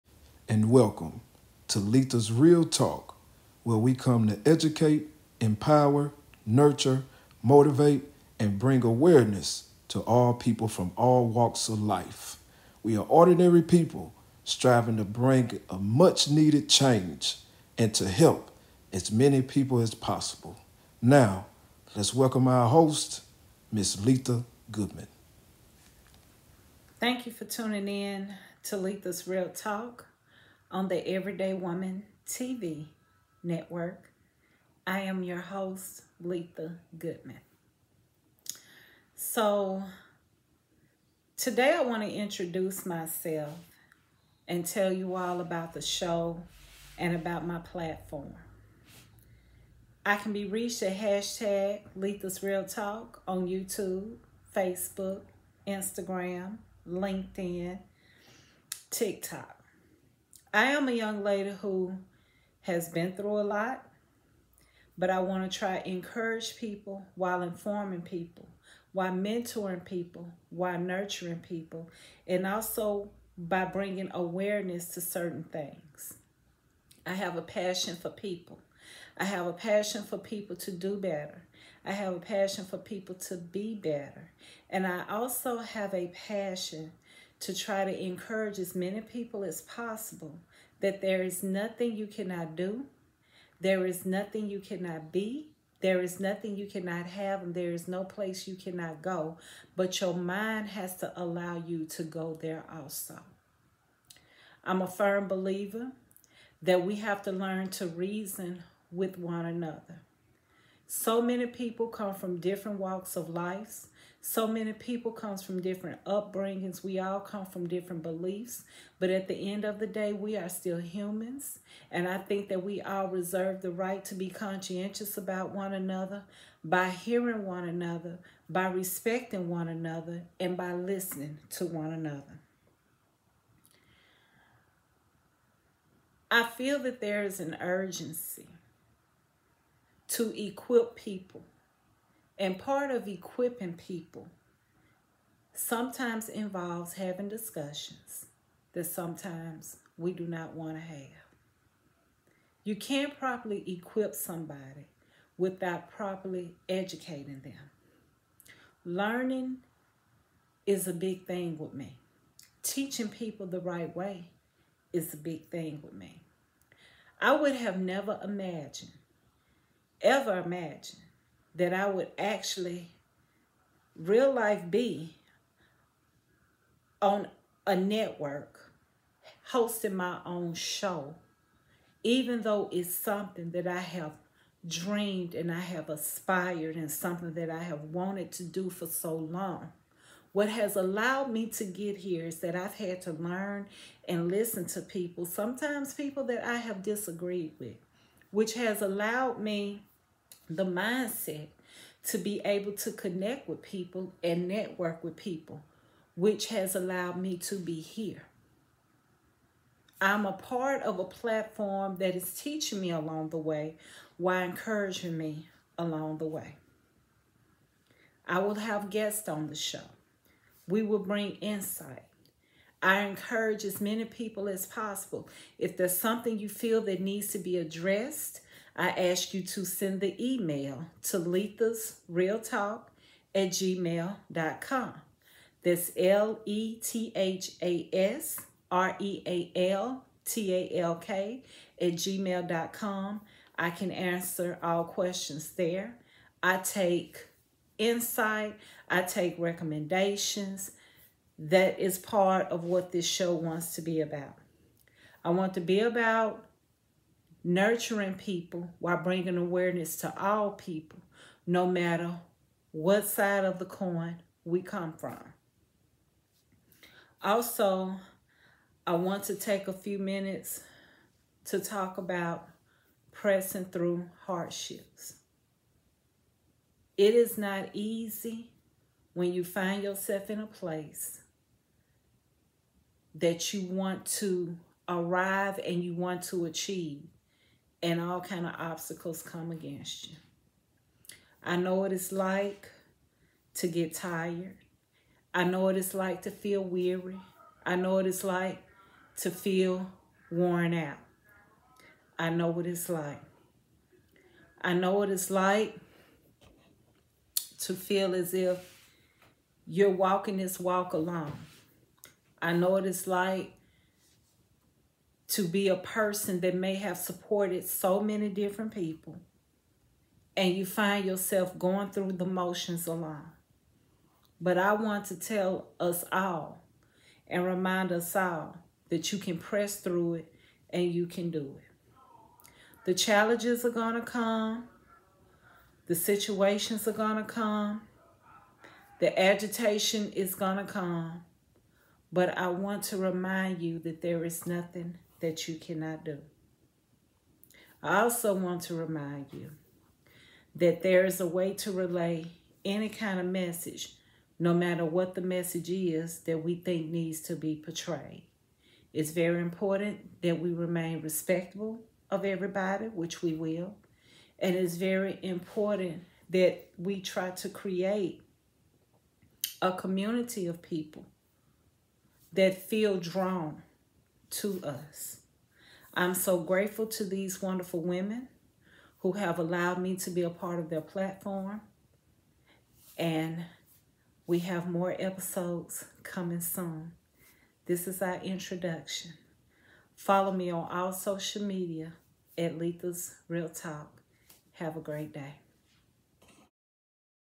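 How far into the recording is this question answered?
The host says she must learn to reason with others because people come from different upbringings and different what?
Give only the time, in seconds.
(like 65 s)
118 s.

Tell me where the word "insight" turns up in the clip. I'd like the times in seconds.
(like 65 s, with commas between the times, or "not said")
221 s, 247 s.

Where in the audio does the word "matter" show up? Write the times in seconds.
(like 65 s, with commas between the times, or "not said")
261 s, 354 s.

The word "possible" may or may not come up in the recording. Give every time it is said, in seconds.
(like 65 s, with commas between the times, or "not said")
19 s, 89 s, 224 s.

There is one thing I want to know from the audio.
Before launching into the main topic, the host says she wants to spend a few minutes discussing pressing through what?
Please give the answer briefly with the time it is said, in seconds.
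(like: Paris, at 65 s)
Hardships, at 274 s.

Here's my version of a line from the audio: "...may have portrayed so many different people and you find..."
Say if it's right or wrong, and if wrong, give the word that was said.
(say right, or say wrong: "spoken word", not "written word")
wrong: "supported", not "portrayed".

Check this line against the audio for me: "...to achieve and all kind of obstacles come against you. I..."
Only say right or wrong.
right.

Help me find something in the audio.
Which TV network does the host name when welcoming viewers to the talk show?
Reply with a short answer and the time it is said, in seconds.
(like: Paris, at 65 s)
Everyday Woman TV, at 31 s.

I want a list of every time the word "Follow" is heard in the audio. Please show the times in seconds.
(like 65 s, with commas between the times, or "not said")
389 s.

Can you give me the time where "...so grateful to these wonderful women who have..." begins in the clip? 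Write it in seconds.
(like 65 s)
376 s.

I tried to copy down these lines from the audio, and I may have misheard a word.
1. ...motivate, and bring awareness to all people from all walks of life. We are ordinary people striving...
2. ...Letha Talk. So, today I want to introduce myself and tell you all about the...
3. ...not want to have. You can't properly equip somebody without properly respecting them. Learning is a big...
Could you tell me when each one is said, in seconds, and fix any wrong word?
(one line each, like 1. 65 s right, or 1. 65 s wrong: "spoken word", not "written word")
1. 7 s right
2. 36 s wrong: "Goodman", not "Talk"
3. 150 s wrong: "educating", not "respecting".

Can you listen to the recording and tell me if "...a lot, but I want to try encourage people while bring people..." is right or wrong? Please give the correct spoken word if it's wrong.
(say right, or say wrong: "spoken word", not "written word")
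wrong: "informing", not "bring".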